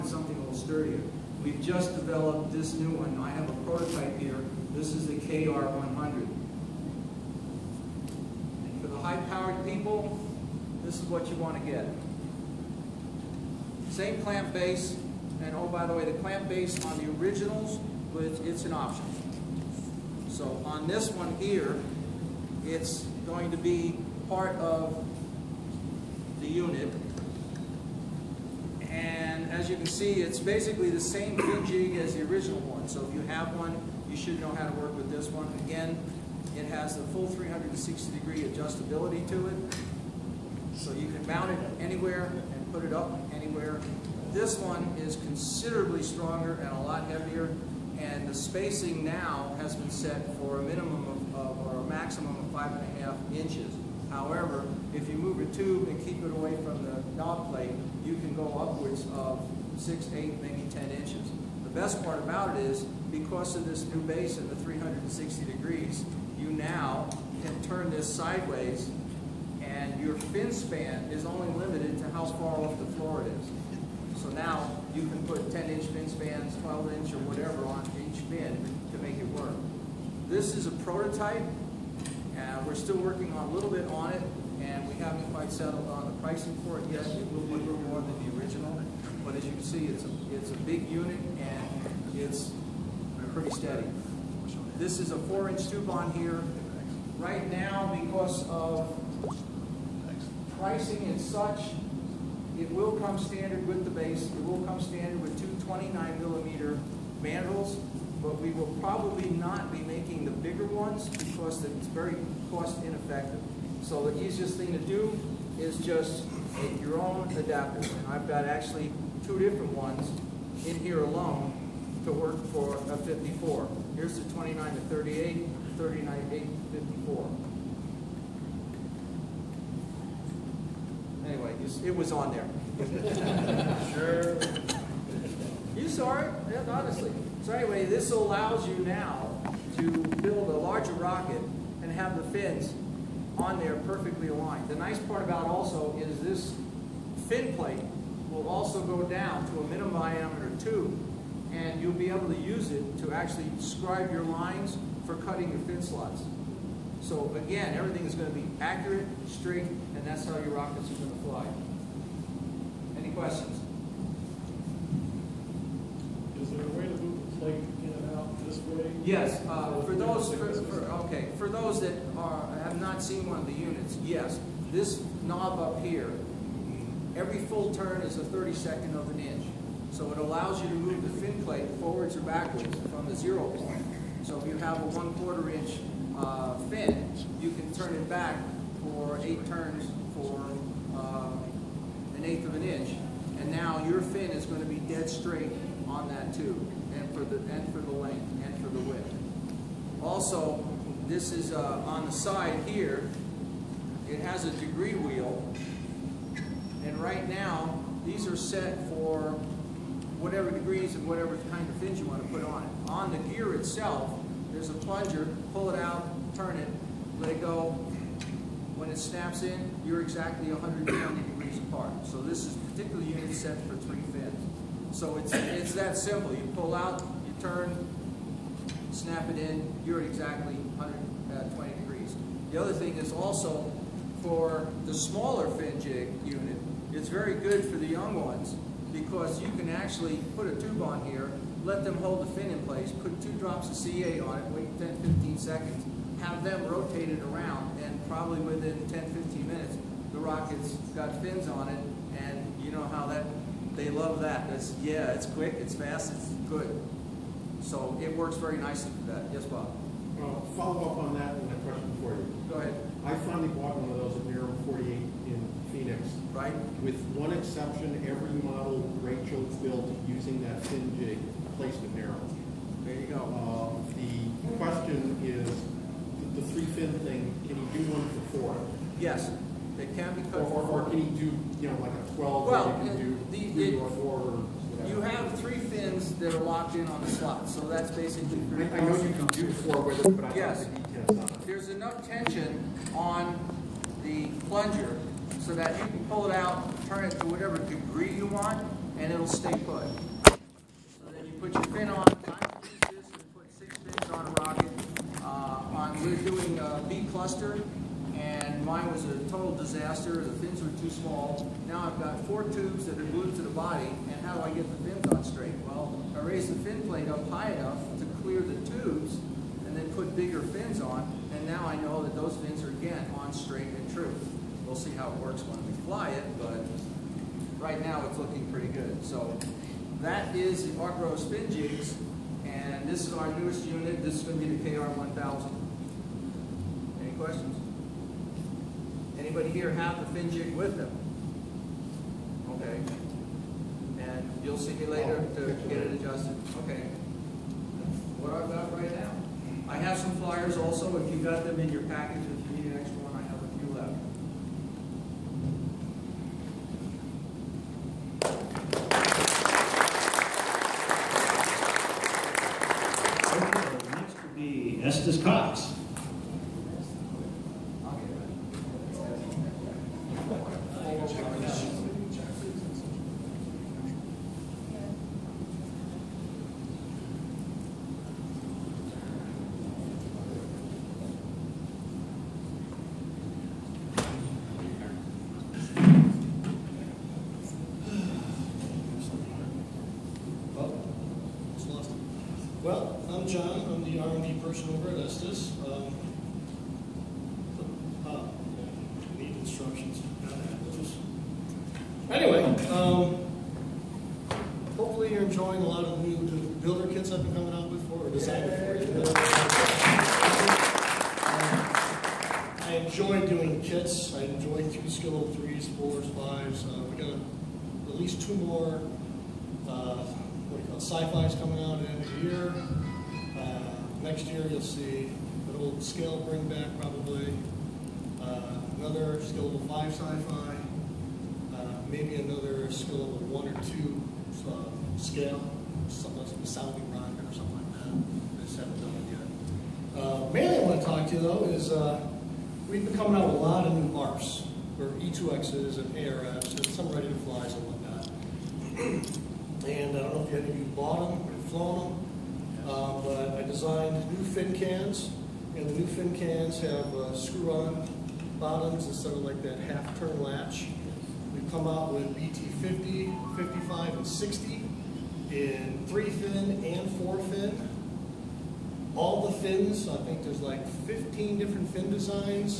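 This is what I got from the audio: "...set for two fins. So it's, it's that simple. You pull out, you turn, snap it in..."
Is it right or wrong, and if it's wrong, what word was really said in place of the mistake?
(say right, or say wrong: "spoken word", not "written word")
wrong: "three", not "two".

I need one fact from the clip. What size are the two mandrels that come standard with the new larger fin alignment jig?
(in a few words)
29 millimeter.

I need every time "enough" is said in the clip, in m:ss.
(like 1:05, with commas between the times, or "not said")
4:51, 5:17.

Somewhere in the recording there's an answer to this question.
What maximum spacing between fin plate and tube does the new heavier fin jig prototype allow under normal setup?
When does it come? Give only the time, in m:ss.
0:52.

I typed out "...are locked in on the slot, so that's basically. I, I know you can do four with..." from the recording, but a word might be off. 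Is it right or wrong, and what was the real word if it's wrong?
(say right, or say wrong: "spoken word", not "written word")
right.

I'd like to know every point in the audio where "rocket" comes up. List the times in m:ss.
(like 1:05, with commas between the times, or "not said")
2:20, 2:40, 4:10, 5:04, 7:16.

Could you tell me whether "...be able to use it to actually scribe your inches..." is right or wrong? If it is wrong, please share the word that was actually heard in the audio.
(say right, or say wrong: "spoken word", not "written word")
wrong: "lines", not "inches".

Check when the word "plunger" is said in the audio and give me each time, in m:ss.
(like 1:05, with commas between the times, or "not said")
3:34, 4:54.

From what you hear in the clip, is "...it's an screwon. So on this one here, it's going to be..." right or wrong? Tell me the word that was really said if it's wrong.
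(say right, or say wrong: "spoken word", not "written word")
wrong: "option", not "screwon".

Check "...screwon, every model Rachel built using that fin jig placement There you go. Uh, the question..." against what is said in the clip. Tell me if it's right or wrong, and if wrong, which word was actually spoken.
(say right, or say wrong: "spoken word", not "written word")
wrong: "exception", not "screwon".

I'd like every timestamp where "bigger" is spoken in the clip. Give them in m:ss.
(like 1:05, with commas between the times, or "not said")
1:50, 5:20.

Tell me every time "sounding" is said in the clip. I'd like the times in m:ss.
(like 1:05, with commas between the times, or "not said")
7:16.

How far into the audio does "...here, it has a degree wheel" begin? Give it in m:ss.
3:22.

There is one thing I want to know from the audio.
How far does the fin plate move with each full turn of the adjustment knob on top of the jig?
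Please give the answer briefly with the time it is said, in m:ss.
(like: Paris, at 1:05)
1/32 of an inch, at 2:58.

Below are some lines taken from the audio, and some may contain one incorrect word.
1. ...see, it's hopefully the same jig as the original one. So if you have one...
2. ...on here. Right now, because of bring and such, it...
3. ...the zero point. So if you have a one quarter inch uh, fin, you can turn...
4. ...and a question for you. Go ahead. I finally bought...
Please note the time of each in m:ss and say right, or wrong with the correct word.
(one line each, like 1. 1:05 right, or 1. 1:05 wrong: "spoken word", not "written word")
1. 0:29 wrong: "basically", not "hopefully"
2. 1:35 wrong: "pricing", not "bring"
3. 3:03 right
4. 4:21 right.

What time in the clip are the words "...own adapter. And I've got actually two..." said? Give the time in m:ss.
1:57.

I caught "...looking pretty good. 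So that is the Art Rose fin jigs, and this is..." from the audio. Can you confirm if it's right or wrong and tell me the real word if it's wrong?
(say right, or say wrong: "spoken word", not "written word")
right.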